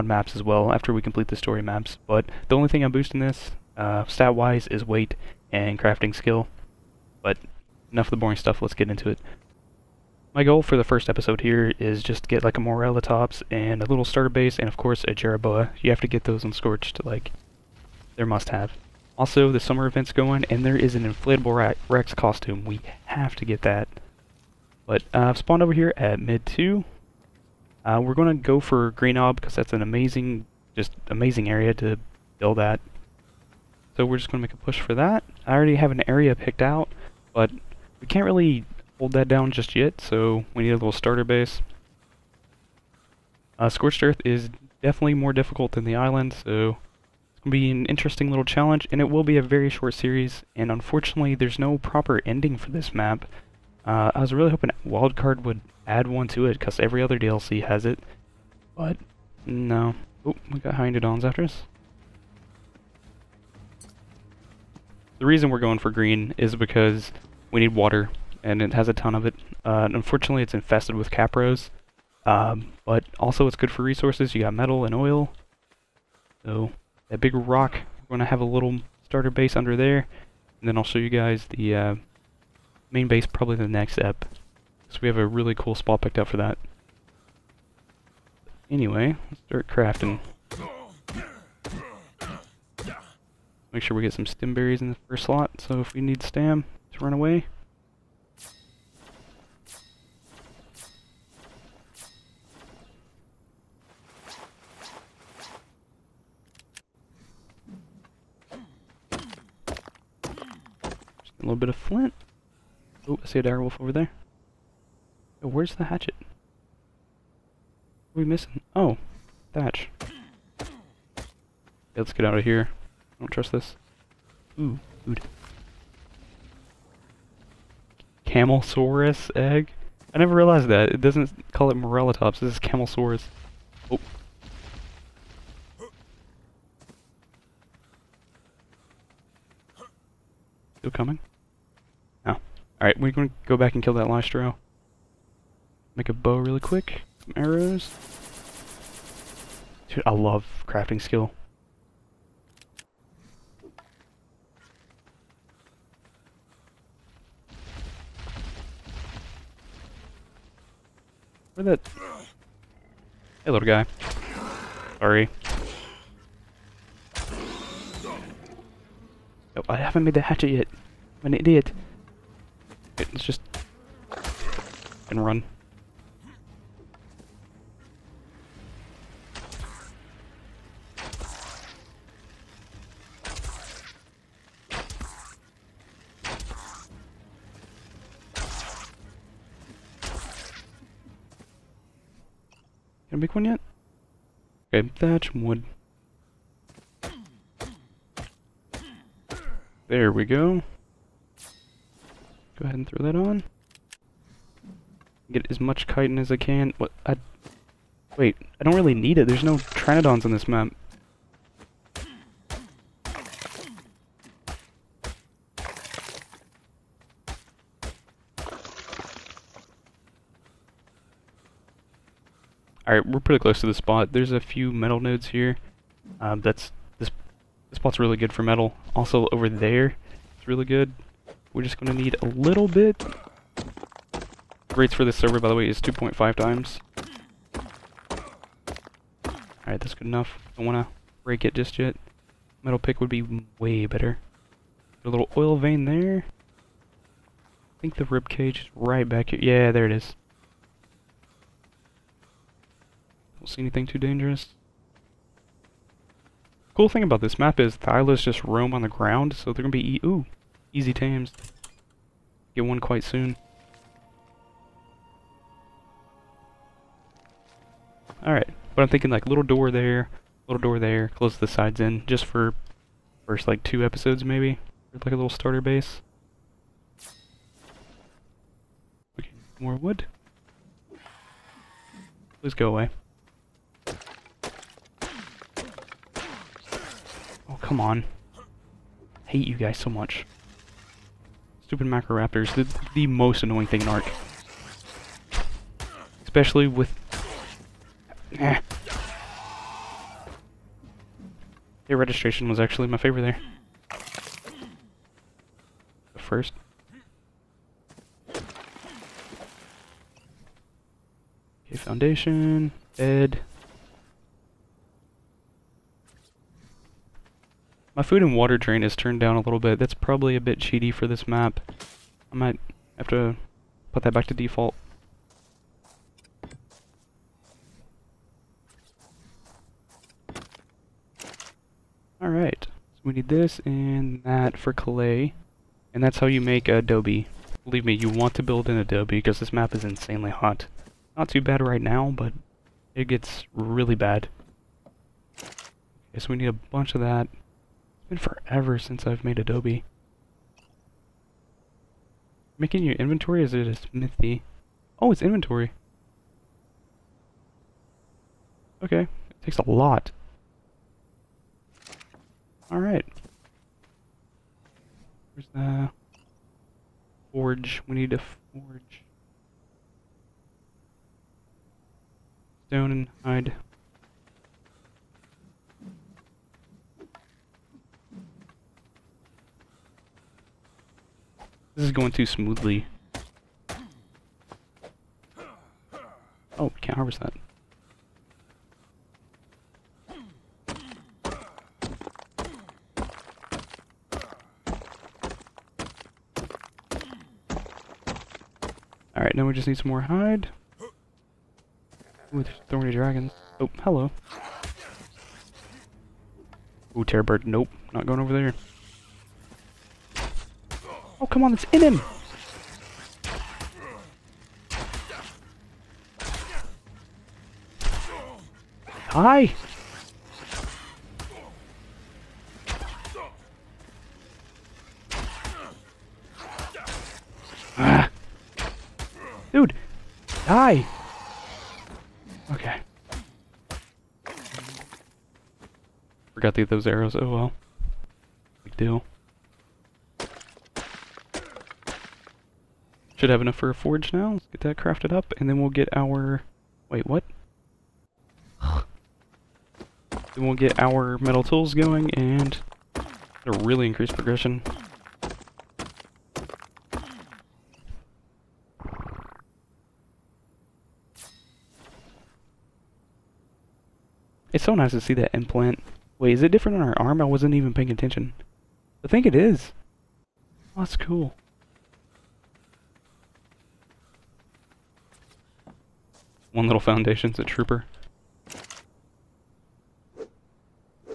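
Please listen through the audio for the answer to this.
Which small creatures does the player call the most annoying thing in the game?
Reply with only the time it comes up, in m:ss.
4:51.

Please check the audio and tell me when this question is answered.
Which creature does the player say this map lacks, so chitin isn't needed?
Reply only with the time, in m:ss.
3:29.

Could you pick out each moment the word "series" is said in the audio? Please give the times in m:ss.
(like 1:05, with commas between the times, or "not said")
0:49.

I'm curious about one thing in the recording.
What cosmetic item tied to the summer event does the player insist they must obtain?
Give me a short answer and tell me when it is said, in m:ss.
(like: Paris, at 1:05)
Inflatable Rex costume, at 0:21.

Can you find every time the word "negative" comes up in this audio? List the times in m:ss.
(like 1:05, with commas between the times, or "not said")
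not said.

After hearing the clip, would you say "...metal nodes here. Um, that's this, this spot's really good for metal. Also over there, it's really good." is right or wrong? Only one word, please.
right.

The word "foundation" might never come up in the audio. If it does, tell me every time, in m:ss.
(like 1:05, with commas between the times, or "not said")
5:11, 7:56.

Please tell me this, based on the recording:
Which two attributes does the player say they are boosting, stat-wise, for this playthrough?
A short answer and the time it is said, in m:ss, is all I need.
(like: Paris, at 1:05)
Weight and crafting skill, at 0:04.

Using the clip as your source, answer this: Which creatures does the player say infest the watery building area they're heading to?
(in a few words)
Capros.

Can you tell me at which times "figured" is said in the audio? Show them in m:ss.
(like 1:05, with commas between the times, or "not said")
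not said.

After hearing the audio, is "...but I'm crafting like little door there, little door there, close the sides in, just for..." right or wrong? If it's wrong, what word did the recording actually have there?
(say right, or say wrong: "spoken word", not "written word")
wrong: "thinking", not "crafting".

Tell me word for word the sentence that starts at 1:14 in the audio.
You got metal and oil, so that big rock.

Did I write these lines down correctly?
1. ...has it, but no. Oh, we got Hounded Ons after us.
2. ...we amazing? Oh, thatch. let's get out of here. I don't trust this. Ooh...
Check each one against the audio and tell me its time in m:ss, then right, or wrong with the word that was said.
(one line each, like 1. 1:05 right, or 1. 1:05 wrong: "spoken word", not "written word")
1. 0:57 right
2. 1:58 wrong: "missing", not "amazing".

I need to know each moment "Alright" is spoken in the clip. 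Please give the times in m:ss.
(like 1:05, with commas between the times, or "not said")
3:42, 3:59, 4:28, 5:32, 6:02, 6:39.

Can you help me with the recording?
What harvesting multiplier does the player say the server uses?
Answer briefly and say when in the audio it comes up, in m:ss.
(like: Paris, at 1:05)
2.5 times, at 3:55.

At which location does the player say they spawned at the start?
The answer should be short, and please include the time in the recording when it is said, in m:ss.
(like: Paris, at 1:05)
Mid 2, at 0:26.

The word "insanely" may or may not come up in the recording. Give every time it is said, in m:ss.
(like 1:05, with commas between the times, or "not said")
5:39.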